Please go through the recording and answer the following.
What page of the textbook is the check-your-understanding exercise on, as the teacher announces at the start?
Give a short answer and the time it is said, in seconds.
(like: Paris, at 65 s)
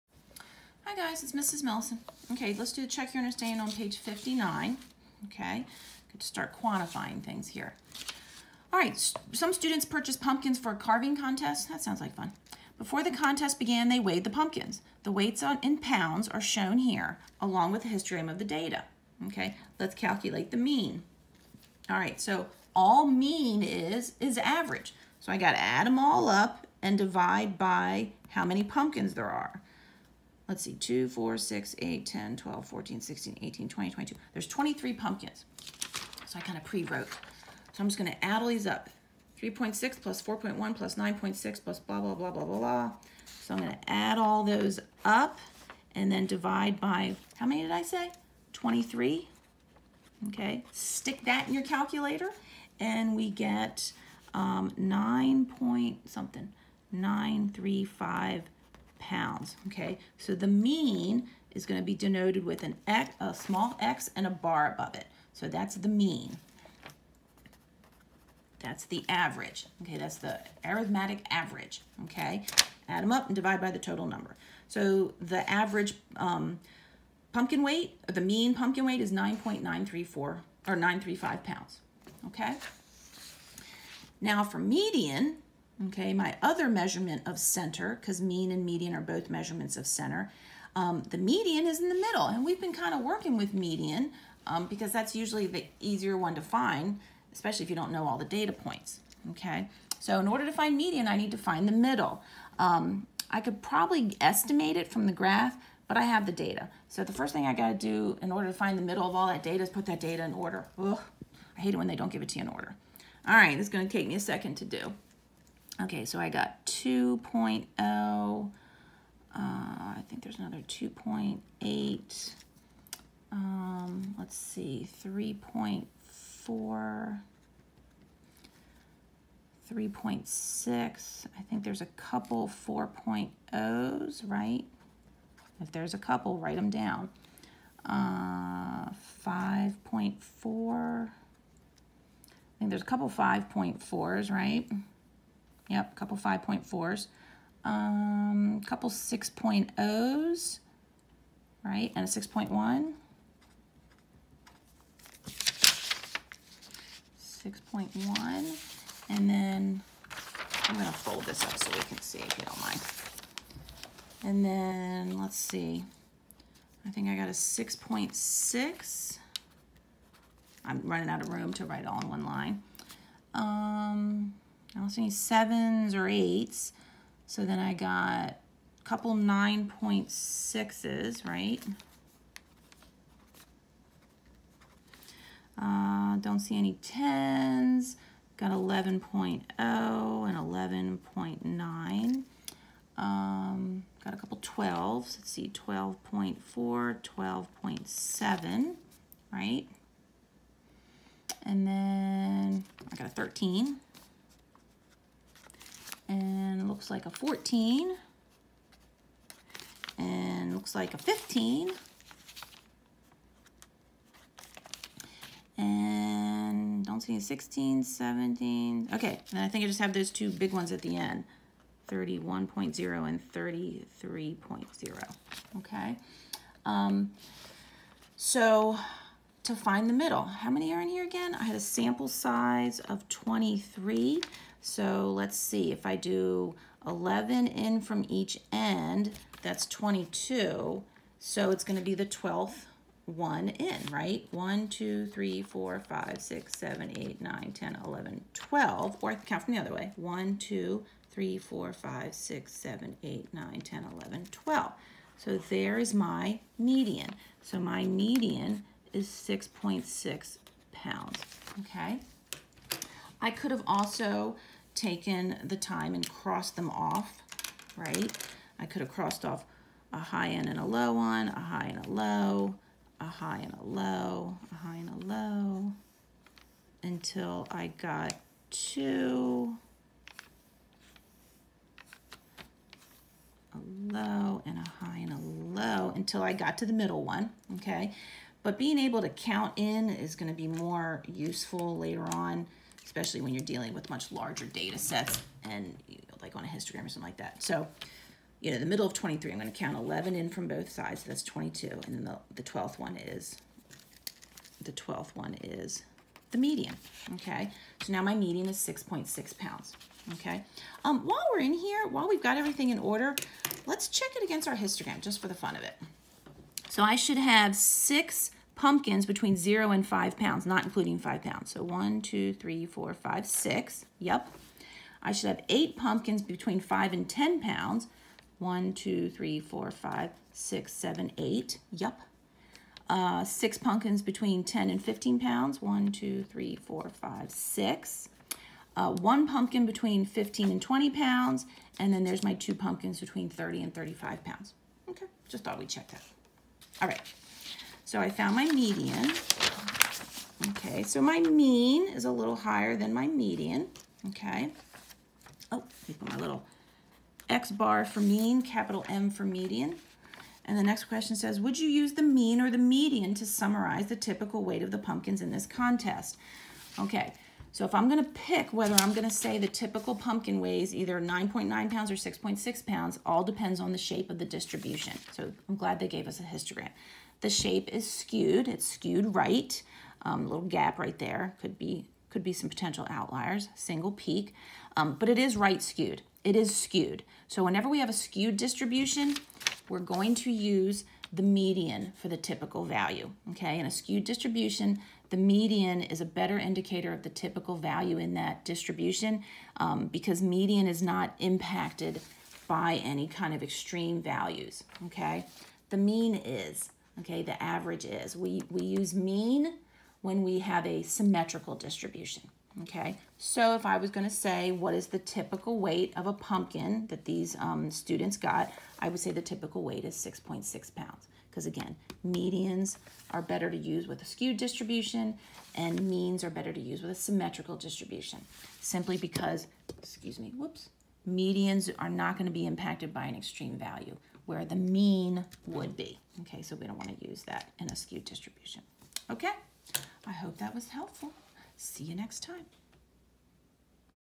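59, at 3 s.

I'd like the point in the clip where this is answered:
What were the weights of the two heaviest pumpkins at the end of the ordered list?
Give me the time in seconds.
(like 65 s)
221 s.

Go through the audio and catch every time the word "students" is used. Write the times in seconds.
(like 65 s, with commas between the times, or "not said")
9 s, 417 s.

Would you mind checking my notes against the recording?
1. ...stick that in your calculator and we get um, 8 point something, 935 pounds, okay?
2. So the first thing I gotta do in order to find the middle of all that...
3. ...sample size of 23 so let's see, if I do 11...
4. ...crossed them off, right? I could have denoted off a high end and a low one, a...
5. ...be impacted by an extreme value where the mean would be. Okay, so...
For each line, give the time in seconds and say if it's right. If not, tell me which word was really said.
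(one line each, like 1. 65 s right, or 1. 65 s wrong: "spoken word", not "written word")
1. 50 s wrong: "9", not "8"
2. 106 s right
3. 231 s right
4. 266 s wrong: "crossed", not "denoted"
5. 432 s right.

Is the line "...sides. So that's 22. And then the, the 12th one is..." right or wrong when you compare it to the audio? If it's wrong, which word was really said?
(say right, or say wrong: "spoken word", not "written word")
right.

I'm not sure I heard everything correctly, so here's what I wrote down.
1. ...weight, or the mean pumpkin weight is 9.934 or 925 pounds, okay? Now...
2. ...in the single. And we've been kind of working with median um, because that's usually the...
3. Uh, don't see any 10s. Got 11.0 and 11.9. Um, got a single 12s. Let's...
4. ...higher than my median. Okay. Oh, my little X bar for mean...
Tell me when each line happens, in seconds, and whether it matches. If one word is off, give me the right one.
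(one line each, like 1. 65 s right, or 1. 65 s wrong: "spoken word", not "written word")
1. 77 s wrong: "935", not "925"
2. 91 s wrong: "middle", not "single"
3. 185 s wrong: "couple", not "single"
4. 352 s right.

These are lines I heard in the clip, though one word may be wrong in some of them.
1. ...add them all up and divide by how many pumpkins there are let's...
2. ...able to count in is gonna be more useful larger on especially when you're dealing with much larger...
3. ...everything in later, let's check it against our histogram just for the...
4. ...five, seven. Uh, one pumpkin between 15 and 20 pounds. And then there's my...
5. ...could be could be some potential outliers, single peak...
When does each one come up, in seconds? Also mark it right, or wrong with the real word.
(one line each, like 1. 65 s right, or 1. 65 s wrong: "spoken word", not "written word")
1. 25 s right
2. 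288 s wrong: "later", not "larger"
3. 312 s wrong: "order", not "later"
4. 336 s wrong: "six", not "seven"
5. 381 s right.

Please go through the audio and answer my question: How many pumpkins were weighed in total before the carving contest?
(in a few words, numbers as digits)
23.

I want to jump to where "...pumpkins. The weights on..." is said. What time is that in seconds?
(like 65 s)
14 s.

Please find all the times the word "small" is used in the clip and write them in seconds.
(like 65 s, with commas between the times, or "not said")
63 s.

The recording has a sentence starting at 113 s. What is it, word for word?
All right, this is gonna take me a second to do.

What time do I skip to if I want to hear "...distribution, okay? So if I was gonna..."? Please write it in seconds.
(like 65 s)
411 s.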